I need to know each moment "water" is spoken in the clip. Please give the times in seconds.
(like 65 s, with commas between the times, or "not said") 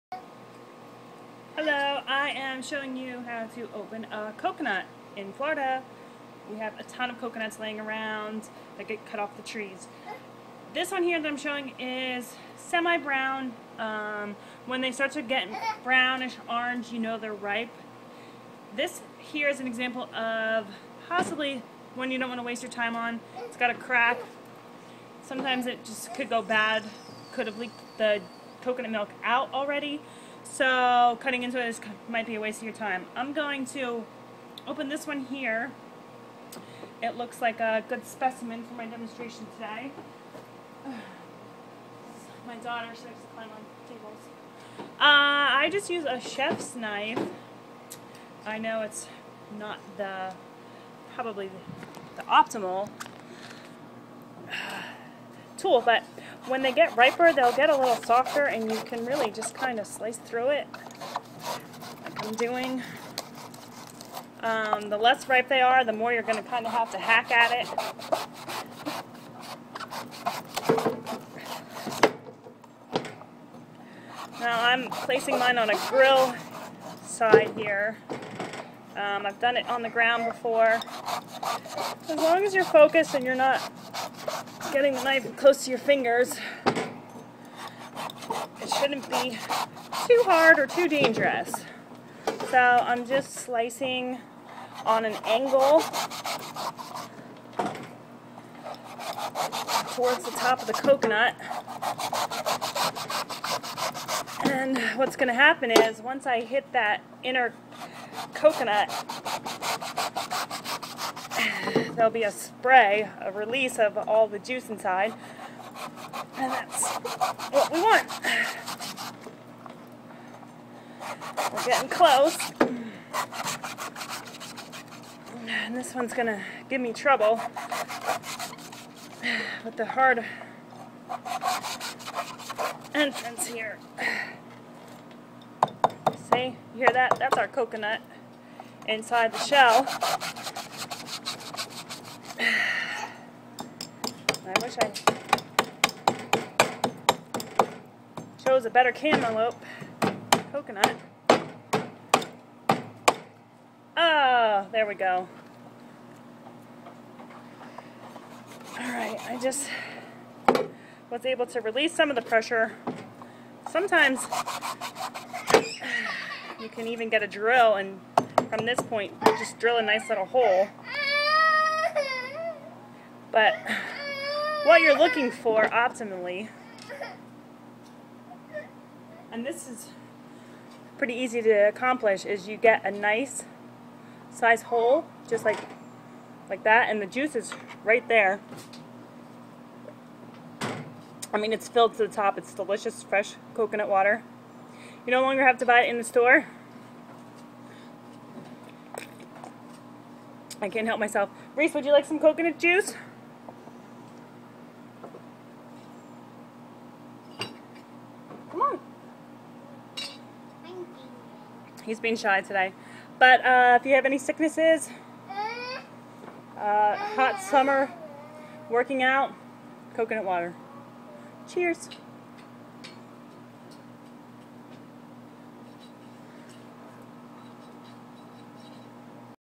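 193 s, 220 s.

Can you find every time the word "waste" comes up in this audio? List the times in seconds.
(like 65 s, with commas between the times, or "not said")
22 s, 32 s.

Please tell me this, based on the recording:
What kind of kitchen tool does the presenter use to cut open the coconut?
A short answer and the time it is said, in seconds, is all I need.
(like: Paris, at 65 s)
chef's knife, at 46 s.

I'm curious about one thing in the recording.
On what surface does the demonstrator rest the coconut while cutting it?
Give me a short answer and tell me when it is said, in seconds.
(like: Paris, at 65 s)
grill side, at 75 s.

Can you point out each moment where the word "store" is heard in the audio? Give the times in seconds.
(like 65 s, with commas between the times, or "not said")
196 s.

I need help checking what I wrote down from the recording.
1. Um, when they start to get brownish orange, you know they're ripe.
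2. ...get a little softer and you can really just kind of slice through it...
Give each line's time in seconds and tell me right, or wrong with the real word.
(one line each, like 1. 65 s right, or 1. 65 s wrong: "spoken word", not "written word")
1. 13 s right
2. 57 s right.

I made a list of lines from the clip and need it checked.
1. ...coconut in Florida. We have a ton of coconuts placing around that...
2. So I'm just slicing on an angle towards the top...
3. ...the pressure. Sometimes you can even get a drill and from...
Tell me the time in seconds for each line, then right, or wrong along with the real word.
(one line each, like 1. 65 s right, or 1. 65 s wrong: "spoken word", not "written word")
1. 4 s wrong: "laying", not "placing"
2. 92 s right
3. 162 s right.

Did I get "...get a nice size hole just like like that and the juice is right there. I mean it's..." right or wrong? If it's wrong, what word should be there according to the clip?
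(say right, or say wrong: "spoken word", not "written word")
right.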